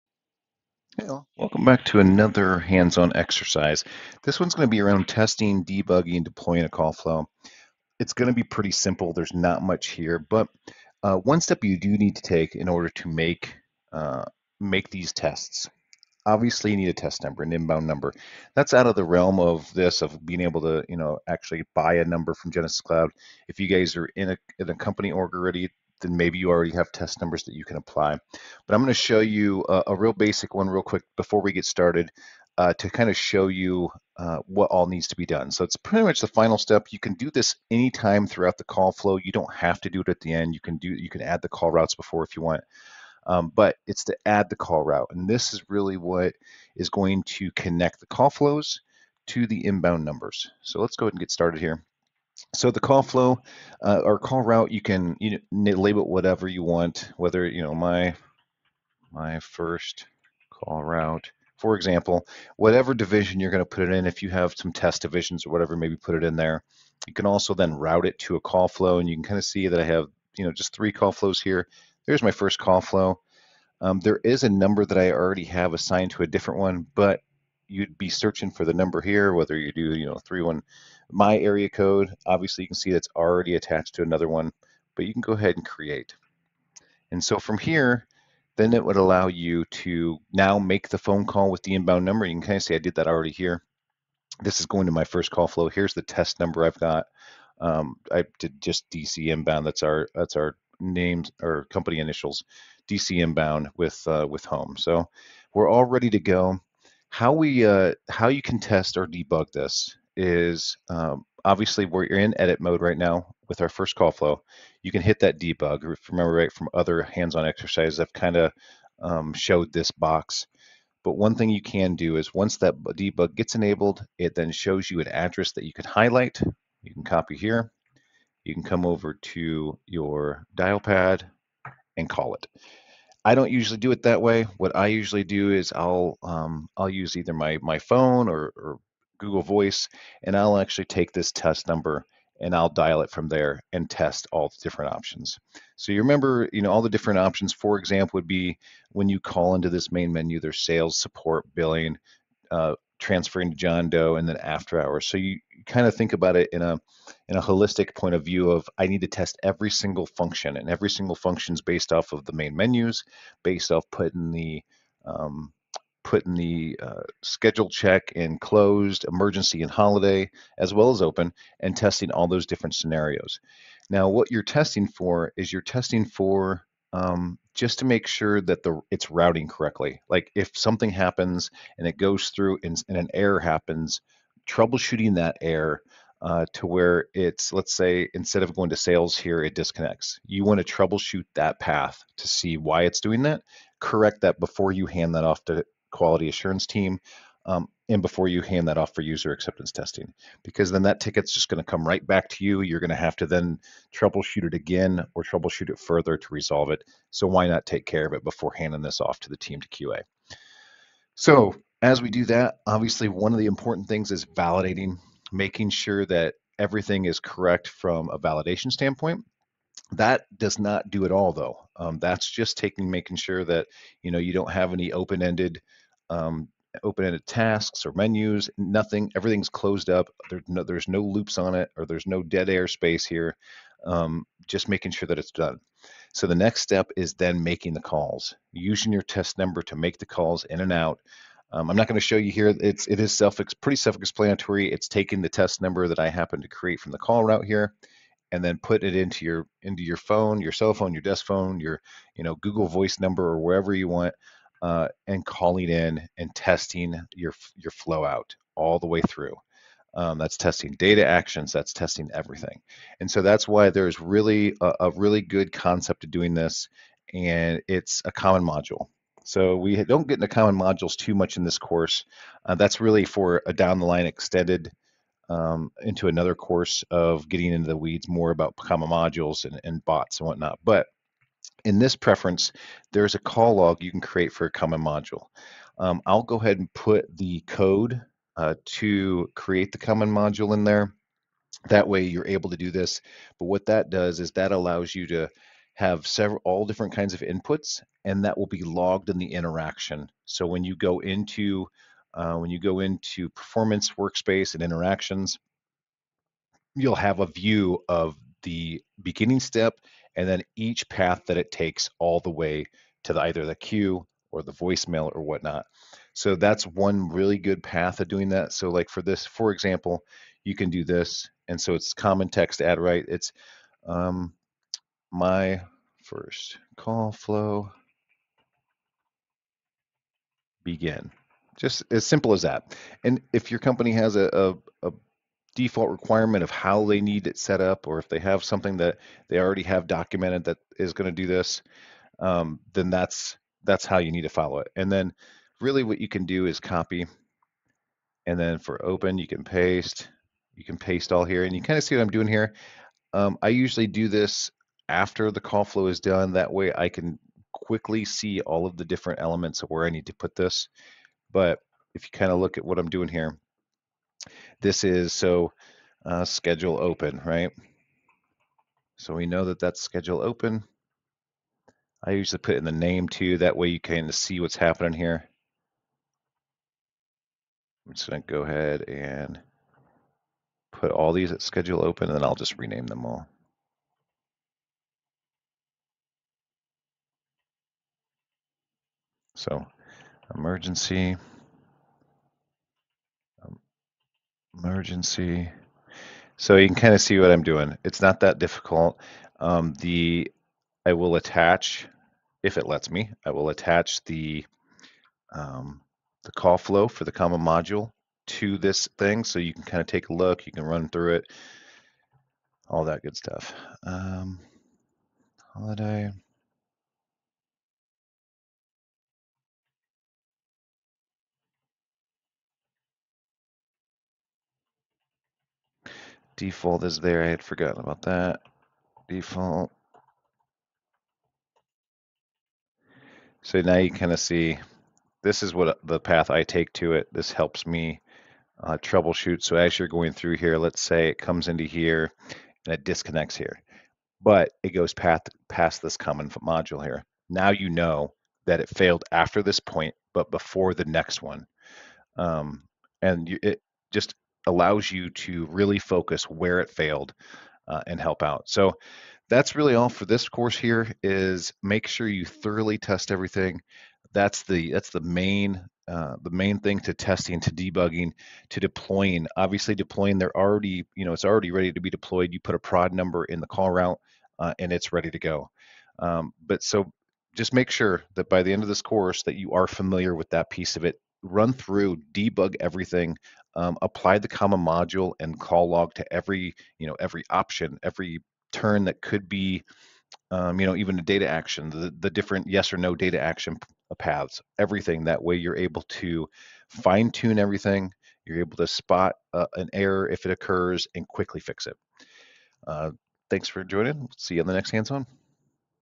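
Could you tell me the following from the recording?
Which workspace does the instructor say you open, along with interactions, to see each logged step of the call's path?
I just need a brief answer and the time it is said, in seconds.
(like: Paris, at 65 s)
Performance workspace, at 303 s.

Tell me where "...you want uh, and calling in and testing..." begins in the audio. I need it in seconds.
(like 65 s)
253 s.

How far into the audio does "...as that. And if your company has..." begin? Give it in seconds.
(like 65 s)
332 s.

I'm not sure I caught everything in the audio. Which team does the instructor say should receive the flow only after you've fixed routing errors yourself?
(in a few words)
Quality assurance team.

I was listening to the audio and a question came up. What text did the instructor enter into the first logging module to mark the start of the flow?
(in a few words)
My first call flow begin.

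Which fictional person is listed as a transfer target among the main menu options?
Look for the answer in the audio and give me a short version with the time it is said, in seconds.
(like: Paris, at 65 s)
John Doe, at 153 s.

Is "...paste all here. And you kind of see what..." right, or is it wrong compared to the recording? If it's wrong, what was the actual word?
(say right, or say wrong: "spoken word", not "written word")
right.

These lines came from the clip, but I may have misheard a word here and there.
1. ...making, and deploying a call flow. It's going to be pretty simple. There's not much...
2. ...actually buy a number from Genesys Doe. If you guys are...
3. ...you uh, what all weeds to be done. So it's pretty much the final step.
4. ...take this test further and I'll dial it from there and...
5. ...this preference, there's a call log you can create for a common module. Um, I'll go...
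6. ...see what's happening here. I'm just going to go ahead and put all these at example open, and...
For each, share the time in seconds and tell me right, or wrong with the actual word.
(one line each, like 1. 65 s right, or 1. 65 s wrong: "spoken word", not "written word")
1. 5 s wrong: "debugging", not "making"
2. 21 s wrong: "Cloud", not "Doe"
3. 33 s wrong: "needs", not "weeds"
4. 140 s wrong: "number", not "further"
5. 281 s right
6. 374 s wrong: "schedule", not "example".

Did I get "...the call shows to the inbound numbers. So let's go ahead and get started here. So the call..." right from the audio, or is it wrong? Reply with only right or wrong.
wrong.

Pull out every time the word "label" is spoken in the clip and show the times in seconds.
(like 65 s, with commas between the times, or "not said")
55 s.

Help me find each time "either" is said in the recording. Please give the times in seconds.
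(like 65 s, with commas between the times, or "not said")
137 s, 313 s.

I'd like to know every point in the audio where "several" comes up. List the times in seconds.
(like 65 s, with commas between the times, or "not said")
296 s.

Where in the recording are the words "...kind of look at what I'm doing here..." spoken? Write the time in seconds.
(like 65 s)
362 s.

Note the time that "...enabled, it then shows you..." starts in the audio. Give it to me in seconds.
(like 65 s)
123 s.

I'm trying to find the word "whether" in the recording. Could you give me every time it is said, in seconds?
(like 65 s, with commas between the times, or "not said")
57 s, 79 s.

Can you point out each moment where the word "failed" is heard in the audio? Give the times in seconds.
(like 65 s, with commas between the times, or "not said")
448 s, 456 s.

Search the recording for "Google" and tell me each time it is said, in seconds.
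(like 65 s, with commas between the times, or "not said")
139 s, 252 s.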